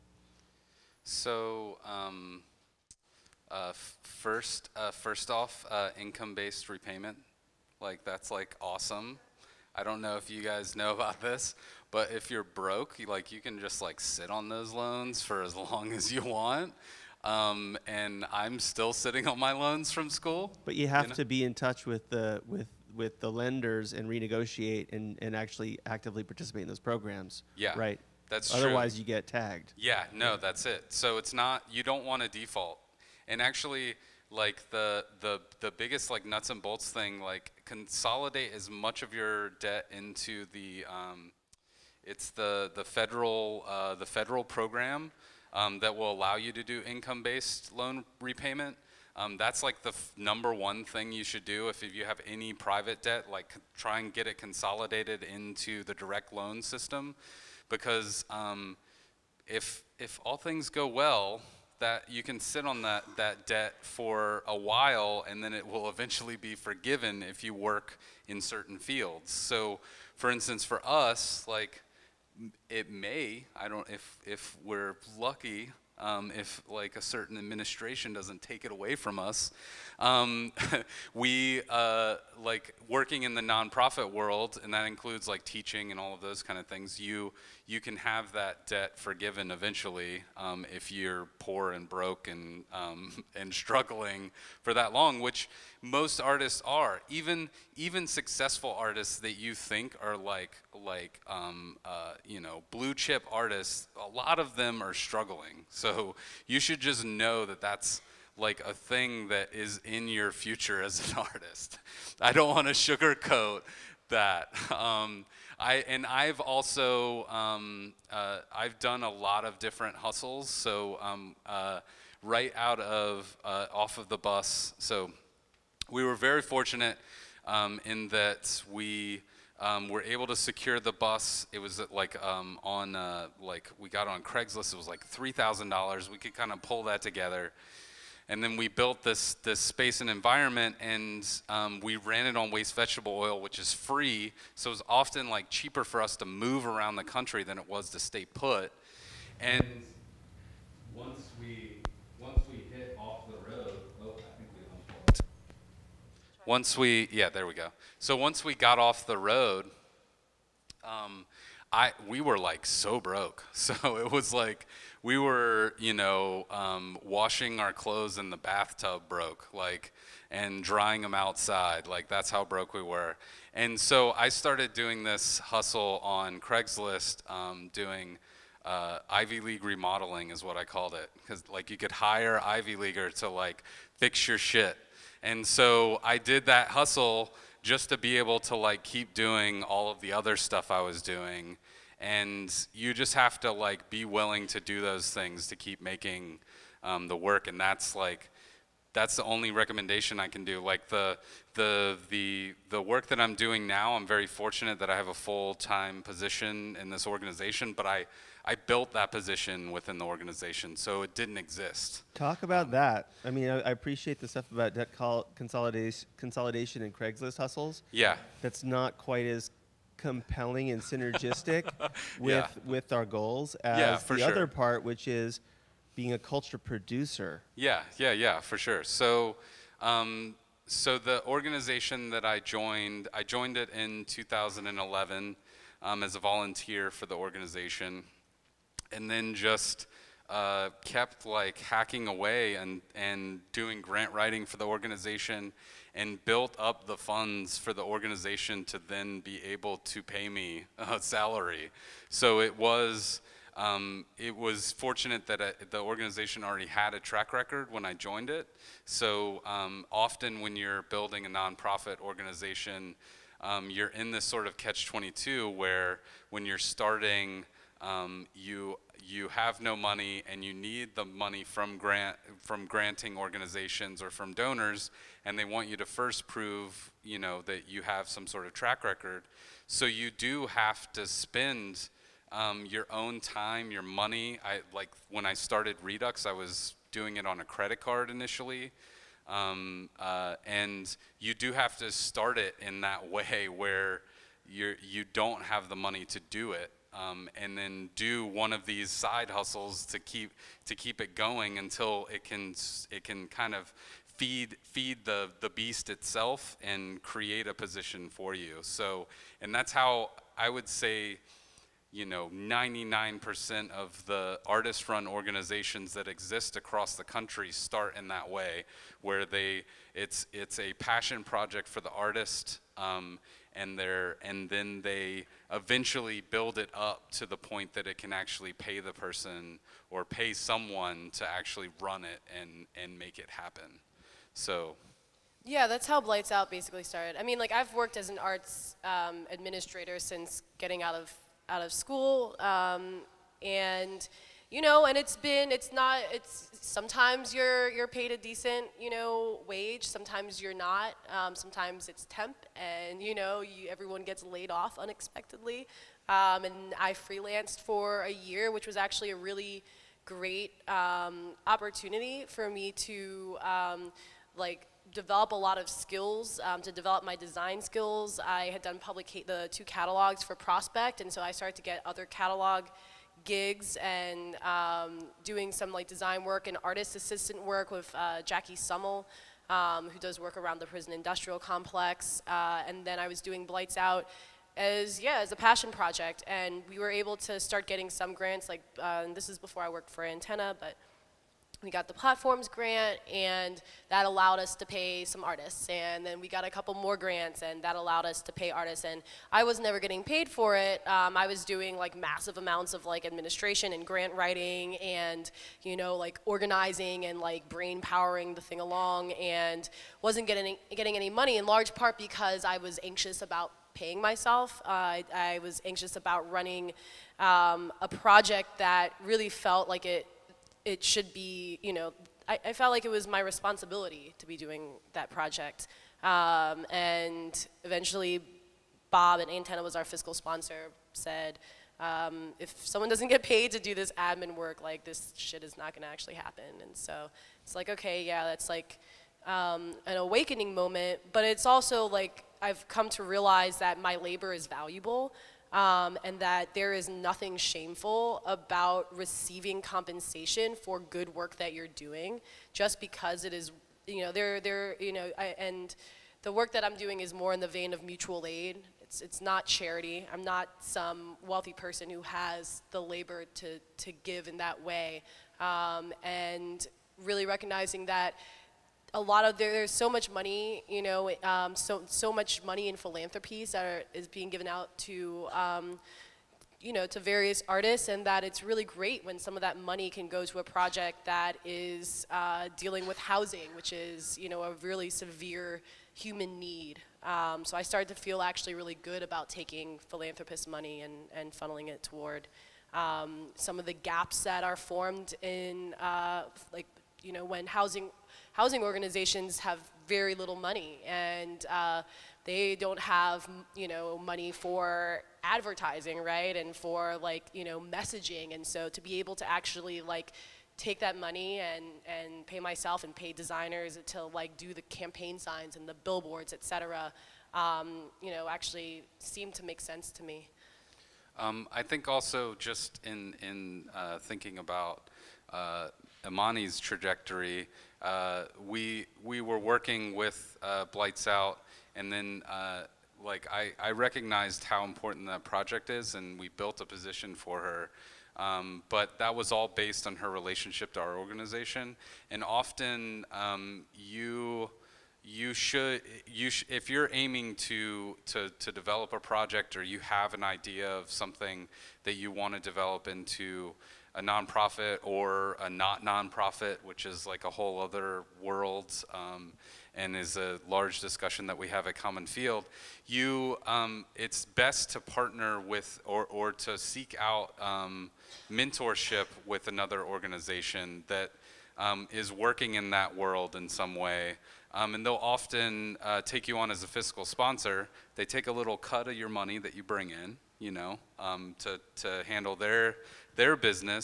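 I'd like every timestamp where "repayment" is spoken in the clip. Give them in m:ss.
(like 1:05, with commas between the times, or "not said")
0:06, 0:48.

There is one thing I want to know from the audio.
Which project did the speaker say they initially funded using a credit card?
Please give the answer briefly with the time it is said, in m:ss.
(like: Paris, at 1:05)
Redux, at 4:45.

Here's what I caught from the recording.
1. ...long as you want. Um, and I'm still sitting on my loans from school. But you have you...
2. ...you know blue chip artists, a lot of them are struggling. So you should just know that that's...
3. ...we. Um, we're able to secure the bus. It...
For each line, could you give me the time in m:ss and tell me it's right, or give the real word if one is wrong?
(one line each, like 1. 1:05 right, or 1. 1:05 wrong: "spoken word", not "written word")
1. 0:15 right
2. 1:42 right
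3. 2:08 right.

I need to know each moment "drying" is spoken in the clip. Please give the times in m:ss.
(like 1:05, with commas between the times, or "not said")
2:50.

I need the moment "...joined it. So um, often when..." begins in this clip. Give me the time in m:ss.
4:17.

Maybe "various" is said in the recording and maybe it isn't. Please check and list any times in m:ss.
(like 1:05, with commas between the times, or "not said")
7:56.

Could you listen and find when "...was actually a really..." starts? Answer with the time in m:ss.
5:58.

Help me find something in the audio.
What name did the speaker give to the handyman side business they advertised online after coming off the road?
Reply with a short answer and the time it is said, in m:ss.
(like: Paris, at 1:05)
Ivy League remodeling, at 2:59.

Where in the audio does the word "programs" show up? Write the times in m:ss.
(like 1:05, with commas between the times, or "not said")
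0:26, 0:44.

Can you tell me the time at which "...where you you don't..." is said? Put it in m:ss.
4:53.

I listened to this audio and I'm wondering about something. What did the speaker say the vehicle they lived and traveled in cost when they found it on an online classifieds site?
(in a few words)
$3,000.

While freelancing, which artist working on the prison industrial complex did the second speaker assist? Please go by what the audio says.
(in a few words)
Jackie Sumell.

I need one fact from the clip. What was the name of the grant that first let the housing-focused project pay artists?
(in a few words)
platforms grant.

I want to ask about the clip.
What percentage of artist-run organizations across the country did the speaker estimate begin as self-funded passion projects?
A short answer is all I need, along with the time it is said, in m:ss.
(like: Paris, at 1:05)
99%, at 5:12.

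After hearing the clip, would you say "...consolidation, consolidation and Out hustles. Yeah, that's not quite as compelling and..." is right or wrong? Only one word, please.
wrong.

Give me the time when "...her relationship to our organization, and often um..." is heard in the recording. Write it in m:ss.
8:59.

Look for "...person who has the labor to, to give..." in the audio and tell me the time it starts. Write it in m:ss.
7:41.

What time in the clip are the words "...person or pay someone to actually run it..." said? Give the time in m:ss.
5:28.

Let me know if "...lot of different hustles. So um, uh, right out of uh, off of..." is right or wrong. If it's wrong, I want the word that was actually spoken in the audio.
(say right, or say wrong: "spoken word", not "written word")
right.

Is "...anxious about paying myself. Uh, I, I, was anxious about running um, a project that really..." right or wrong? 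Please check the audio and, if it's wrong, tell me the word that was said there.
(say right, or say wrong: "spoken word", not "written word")
right.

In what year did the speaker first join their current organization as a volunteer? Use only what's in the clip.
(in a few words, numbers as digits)
2011.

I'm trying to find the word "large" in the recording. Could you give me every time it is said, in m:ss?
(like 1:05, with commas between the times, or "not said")
6:51, 9:20.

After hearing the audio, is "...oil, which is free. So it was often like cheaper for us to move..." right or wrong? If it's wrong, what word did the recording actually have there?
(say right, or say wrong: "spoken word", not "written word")
right.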